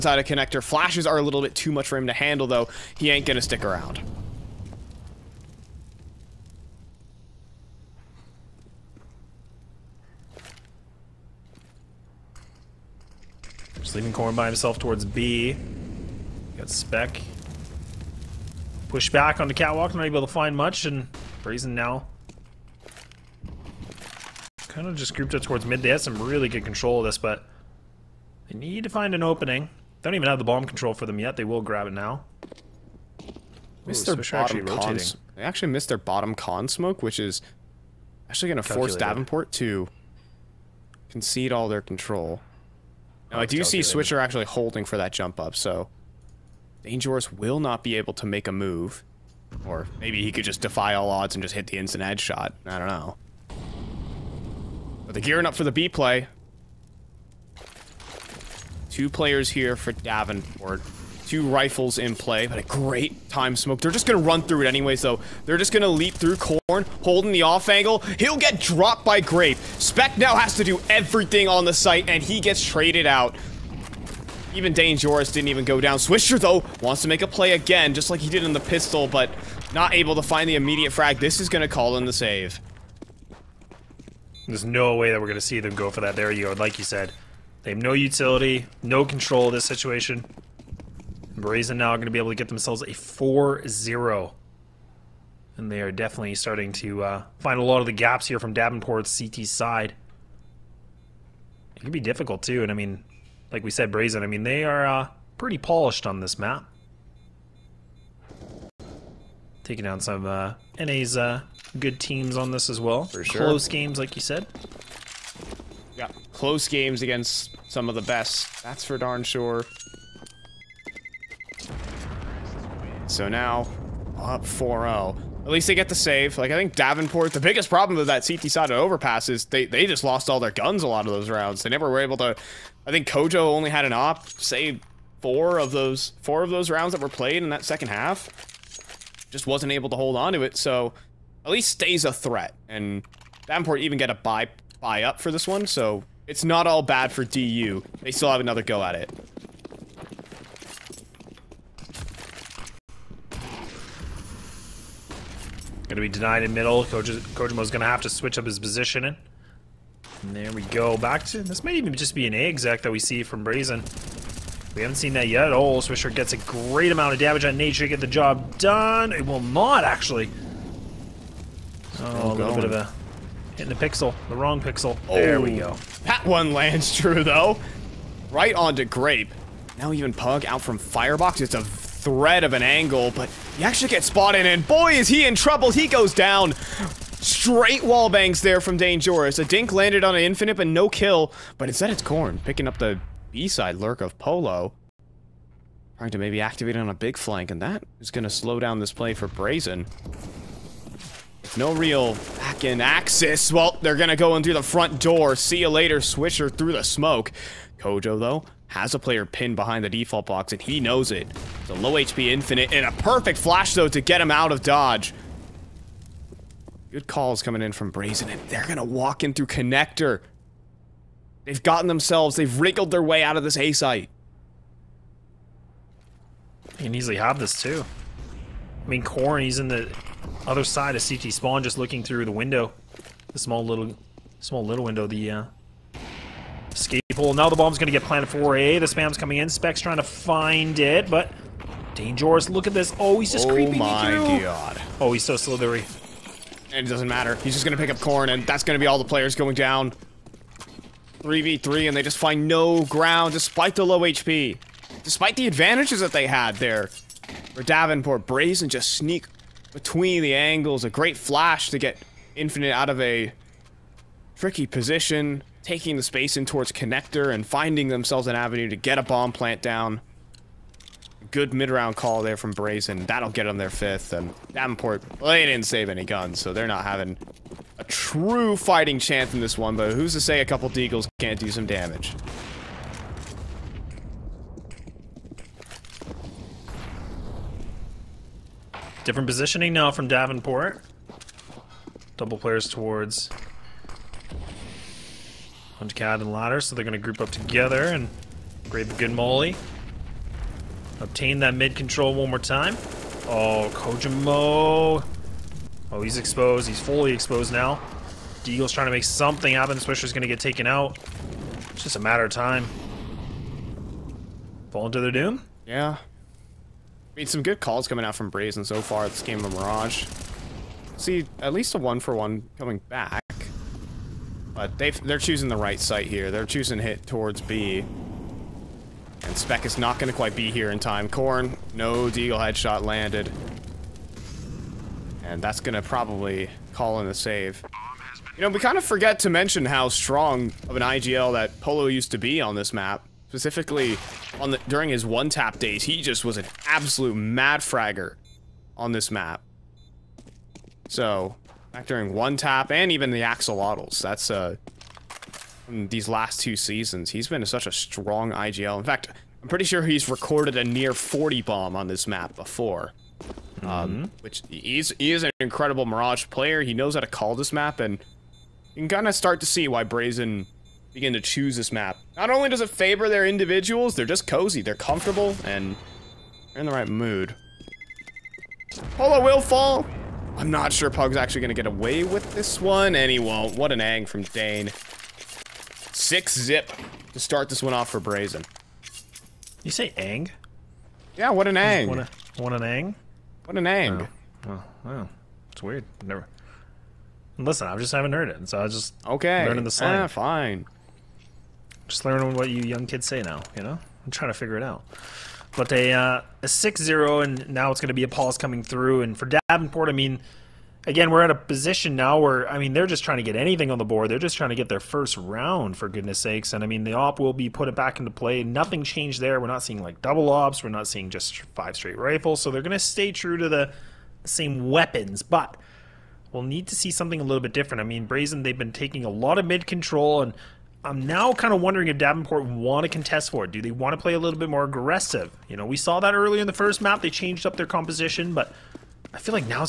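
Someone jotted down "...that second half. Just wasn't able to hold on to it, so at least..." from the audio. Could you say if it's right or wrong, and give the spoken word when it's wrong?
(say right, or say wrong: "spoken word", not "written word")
right.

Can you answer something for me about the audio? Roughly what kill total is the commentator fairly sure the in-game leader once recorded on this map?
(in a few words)
40.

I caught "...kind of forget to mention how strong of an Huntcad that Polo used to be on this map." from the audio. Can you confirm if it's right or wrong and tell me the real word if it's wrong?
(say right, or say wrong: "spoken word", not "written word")
wrong: "IGL", not "Huntcad".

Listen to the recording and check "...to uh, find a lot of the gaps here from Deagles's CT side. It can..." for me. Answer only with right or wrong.
wrong.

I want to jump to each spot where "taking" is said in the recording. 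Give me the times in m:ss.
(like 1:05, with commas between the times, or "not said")
1:49, 4:25, 7:08.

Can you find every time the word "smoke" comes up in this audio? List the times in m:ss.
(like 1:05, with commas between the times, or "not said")
0:36, 1:03, 3:26.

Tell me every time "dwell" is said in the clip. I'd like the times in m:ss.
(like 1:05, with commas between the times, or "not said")
not said.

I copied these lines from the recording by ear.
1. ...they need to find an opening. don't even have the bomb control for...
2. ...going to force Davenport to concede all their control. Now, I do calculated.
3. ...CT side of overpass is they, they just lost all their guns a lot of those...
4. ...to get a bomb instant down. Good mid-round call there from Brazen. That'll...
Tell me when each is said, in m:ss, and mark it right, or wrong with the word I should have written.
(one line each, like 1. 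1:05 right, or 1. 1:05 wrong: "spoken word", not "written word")
1. 0:28 right
2. 0:38 right
3. 2:08 right
4. 4:28 wrong: "plant", not "instant".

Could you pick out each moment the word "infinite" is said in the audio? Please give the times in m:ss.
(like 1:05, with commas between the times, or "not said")
3:10, 3:32, 4:22.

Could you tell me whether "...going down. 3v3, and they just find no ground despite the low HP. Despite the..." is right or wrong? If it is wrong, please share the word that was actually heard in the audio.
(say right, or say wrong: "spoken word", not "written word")
right.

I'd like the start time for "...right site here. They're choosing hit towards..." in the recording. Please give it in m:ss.
5:25.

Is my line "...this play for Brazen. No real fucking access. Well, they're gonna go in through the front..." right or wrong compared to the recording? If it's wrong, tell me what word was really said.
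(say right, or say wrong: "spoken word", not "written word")
right.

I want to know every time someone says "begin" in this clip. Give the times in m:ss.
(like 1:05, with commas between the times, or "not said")
6:10.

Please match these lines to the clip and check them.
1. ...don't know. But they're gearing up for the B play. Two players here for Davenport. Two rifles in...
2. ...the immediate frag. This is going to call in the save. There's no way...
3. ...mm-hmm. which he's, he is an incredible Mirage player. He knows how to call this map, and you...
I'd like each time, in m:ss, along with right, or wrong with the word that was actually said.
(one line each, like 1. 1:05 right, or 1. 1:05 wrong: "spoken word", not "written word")
1. 0:52 right
2. 1:20 right
3. 6:03 right.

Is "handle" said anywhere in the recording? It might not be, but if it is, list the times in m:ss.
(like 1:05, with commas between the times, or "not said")
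0:02.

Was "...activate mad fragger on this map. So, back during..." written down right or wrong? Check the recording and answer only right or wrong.
wrong.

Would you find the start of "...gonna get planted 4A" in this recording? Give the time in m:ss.
3:57.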